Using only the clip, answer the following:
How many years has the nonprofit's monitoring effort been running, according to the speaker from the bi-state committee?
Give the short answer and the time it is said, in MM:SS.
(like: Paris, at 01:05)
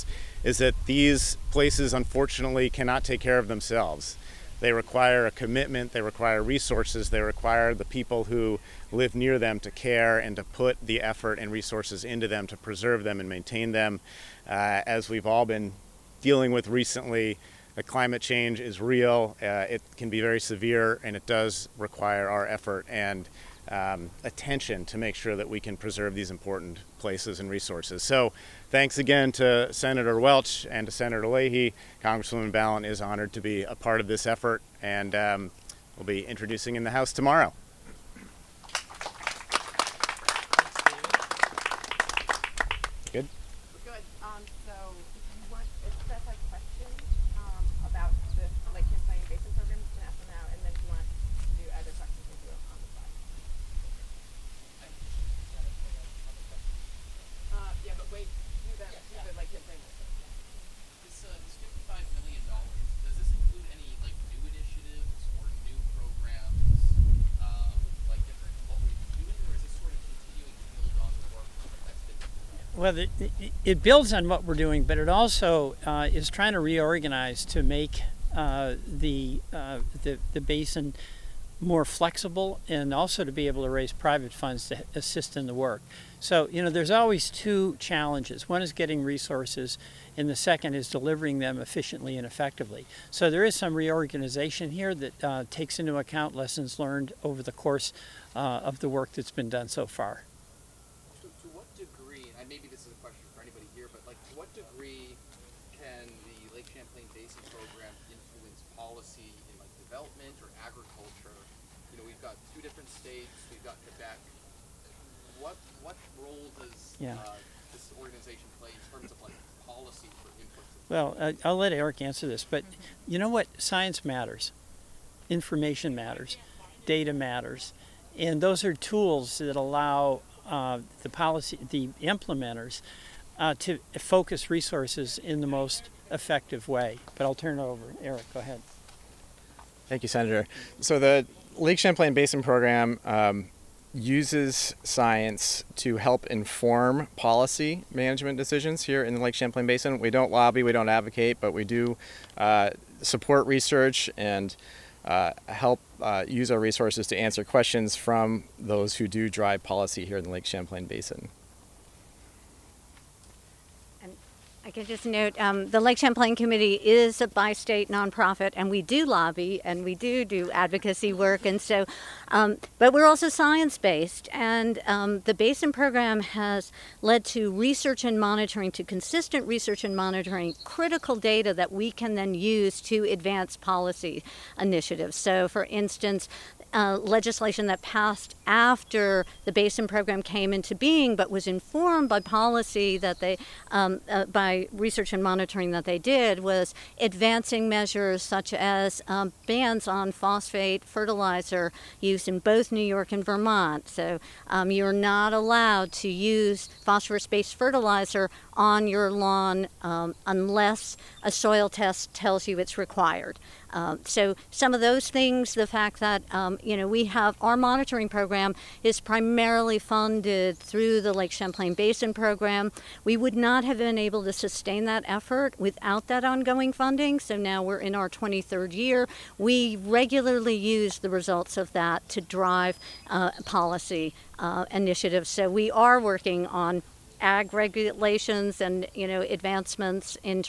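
23rd year, at 03:48.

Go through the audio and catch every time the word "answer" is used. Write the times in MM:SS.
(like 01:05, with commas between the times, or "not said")
02:02, 02:37.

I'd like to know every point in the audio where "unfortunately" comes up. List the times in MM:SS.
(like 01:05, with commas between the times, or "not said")
00:01.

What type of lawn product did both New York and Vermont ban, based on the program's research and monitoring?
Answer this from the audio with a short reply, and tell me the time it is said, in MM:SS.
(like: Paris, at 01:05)
Phosphate fertilizer, at 03:20.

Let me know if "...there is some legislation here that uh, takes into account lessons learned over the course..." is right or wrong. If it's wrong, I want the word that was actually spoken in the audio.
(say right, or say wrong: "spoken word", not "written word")
wrong: "reorganization", not "legislation".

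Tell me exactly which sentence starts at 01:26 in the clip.
So, you know, there's always two challenges.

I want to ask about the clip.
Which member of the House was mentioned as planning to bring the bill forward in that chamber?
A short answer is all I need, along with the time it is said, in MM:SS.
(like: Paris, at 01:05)
Congresswoman Balint, at 00:32.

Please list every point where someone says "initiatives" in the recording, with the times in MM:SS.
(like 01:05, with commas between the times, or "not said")
03:04, 03:54.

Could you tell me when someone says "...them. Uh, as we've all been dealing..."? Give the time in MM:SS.
00:13.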